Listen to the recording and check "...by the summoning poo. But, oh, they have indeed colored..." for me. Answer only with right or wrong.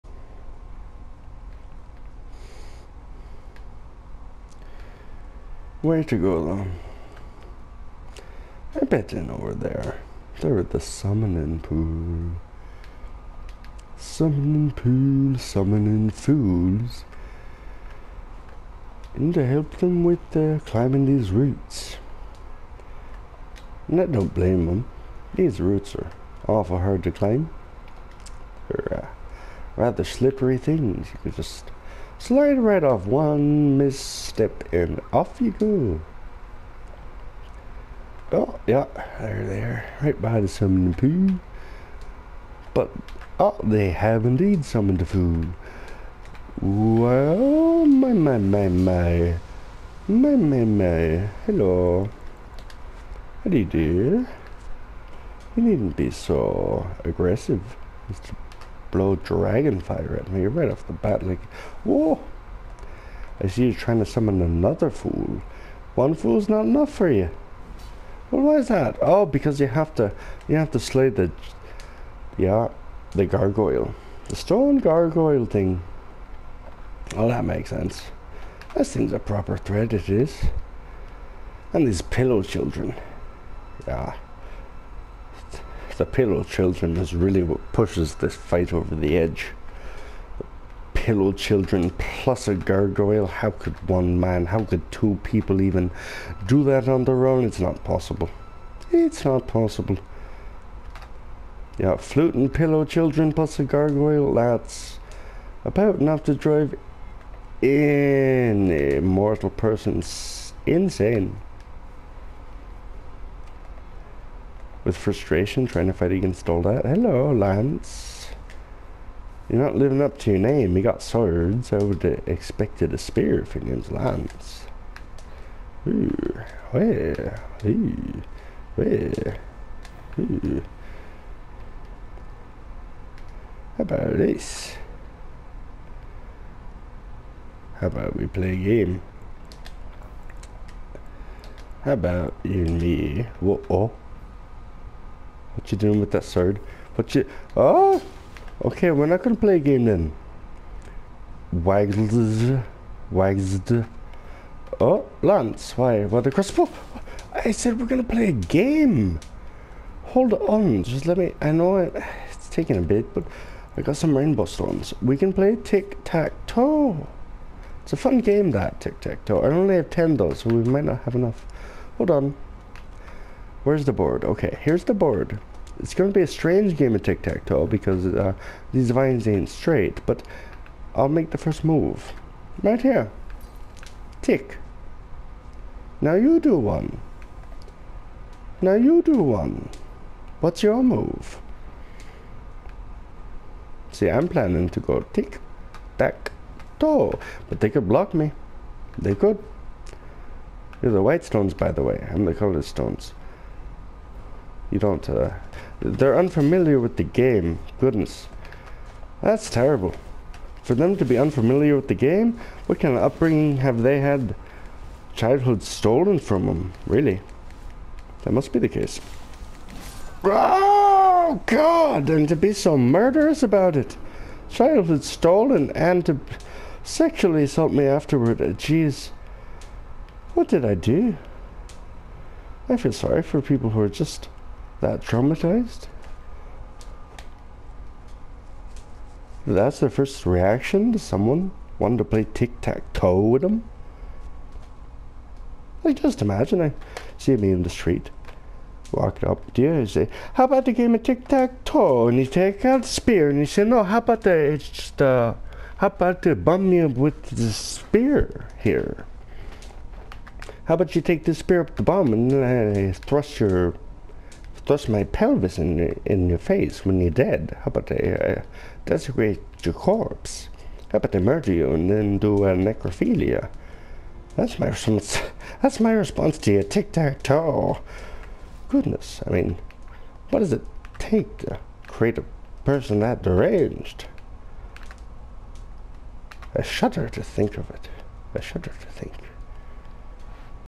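wrong.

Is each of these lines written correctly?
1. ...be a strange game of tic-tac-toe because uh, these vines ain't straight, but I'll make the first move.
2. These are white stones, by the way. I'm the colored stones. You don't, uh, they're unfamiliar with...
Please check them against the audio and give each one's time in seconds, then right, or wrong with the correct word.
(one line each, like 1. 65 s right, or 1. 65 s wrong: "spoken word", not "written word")
1. 176 s right
2. 200 s right.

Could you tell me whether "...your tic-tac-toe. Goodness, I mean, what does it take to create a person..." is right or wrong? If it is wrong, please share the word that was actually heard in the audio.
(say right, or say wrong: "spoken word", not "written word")
right.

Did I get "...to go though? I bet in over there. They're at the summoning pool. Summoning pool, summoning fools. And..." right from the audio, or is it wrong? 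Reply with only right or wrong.
right.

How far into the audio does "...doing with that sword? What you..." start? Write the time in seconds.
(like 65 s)
145 s.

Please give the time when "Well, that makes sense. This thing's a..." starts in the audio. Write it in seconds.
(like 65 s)
77 s.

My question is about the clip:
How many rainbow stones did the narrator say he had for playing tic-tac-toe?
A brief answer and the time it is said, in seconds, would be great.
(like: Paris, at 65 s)
10, at 169 s.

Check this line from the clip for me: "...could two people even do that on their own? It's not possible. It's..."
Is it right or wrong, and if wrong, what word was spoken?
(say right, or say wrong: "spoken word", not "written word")
right.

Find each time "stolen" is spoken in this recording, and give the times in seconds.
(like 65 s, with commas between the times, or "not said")
215 s, 225 s.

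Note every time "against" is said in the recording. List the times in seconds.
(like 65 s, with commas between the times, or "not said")
116 s.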